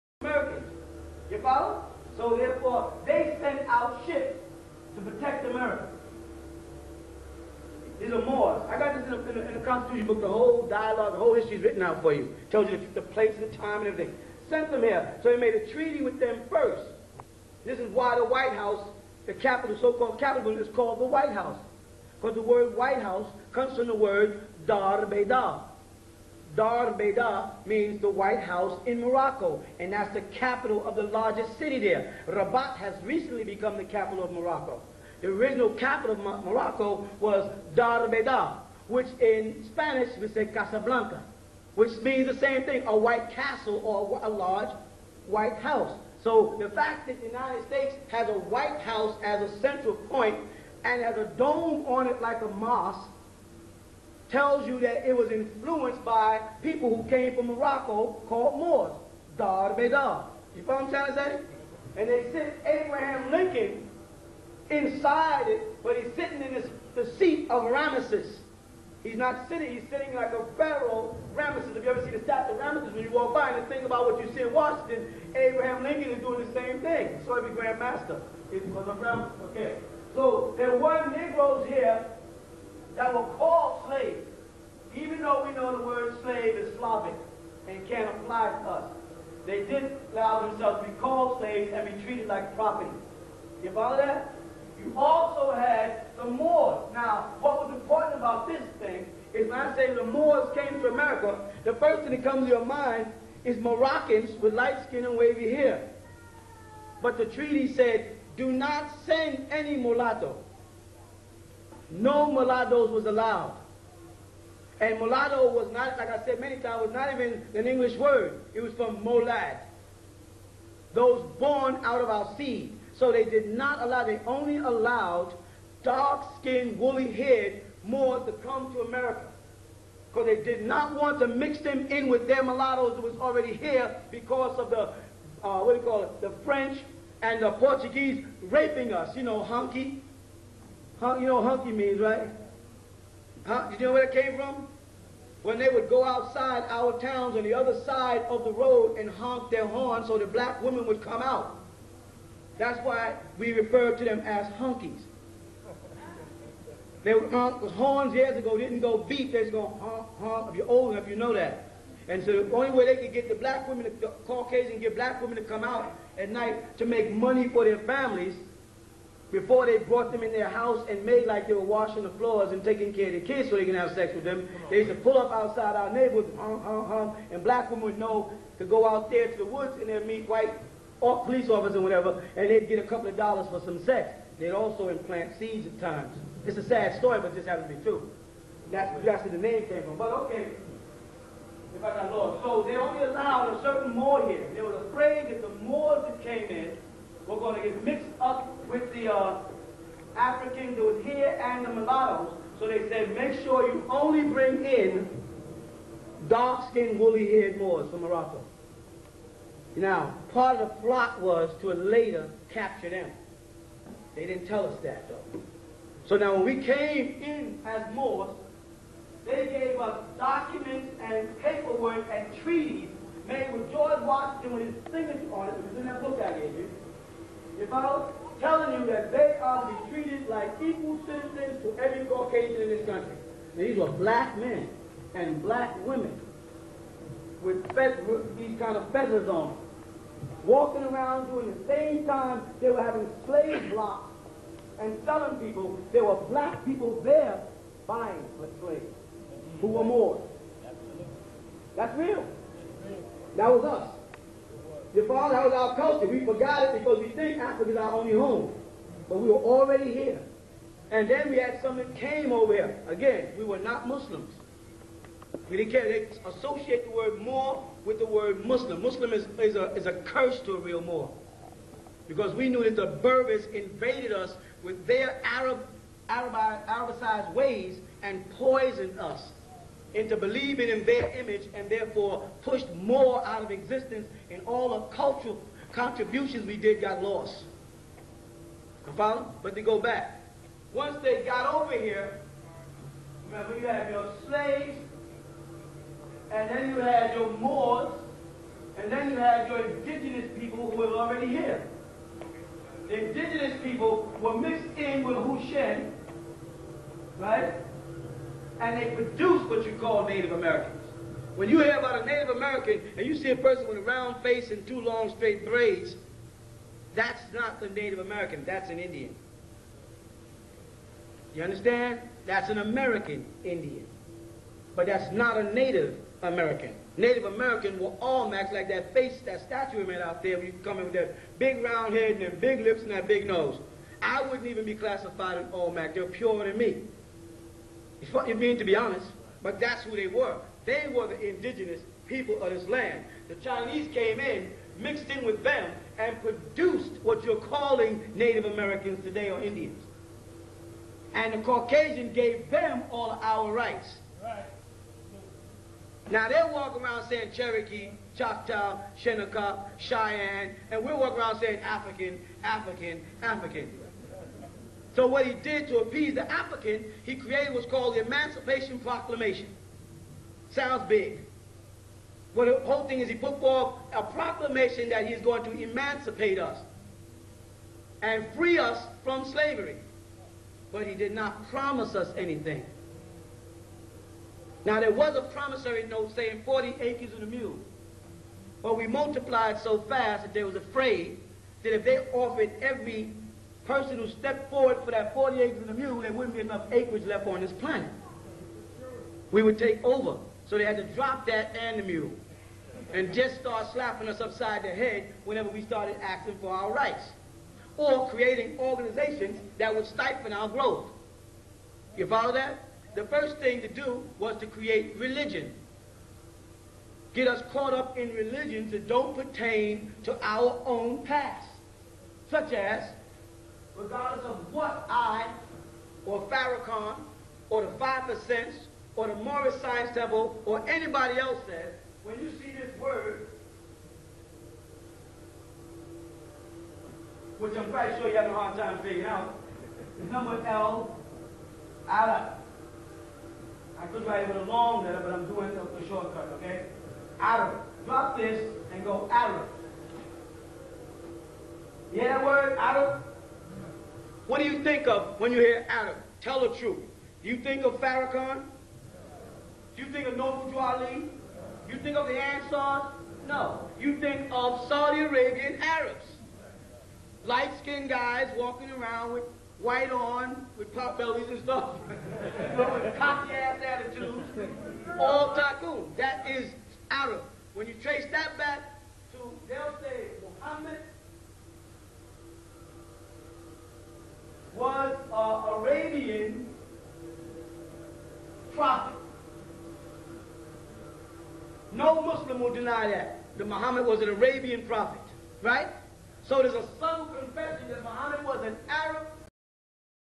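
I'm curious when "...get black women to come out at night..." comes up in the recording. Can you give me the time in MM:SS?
02:44.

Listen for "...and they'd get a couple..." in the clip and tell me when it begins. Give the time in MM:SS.
03:02.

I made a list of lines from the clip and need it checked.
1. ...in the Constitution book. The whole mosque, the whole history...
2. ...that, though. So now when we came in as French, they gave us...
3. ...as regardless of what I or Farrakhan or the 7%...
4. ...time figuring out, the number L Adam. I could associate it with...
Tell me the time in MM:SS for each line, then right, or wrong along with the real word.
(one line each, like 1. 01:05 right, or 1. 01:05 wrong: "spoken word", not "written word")
1. 00:09 wrong: "dialogue", not "mosque"
2. 03:34 wrong: "Moors", not "French"
3. 07:02 wrong: "5", not "7"
4. 07:18 wrong: "write", not "associate".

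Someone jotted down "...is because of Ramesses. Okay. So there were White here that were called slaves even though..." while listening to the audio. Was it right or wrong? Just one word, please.
wrong.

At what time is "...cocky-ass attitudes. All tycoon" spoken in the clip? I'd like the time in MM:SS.
07:52.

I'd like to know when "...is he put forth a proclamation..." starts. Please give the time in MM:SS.
06:12.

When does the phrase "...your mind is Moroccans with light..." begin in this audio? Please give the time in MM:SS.
01:42.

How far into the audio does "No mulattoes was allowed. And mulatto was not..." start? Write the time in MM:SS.
01:51.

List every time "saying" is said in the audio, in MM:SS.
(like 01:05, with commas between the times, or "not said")
05:57, 06:01, 06:26.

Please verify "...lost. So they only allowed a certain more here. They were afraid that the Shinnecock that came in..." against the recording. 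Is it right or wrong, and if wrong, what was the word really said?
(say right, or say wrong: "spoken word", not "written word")
wrong: "Moors", not "Shinnecock".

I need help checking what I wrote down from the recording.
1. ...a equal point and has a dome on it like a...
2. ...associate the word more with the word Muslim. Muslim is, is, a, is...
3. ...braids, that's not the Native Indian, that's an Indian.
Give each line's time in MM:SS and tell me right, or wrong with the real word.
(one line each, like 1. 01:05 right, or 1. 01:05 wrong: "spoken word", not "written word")
1. 00:49 wrong: "central", not "equal"
2. 04:26 right
3. 05:15 wrong: "American", not "Indian".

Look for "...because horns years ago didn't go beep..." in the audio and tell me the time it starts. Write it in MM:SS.
02:37.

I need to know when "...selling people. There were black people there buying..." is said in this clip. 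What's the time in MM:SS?
04:05.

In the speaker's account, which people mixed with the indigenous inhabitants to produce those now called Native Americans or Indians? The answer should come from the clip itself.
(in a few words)
Chinese.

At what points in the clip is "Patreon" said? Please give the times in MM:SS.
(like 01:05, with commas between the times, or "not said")
not said.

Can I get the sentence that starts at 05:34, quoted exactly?
I wouldn't even be classified an Mac.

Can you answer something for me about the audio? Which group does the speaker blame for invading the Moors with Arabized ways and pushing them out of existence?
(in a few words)
Berbers.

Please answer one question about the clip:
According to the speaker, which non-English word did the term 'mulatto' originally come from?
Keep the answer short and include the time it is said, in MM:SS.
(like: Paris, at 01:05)
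molad, at 01:59.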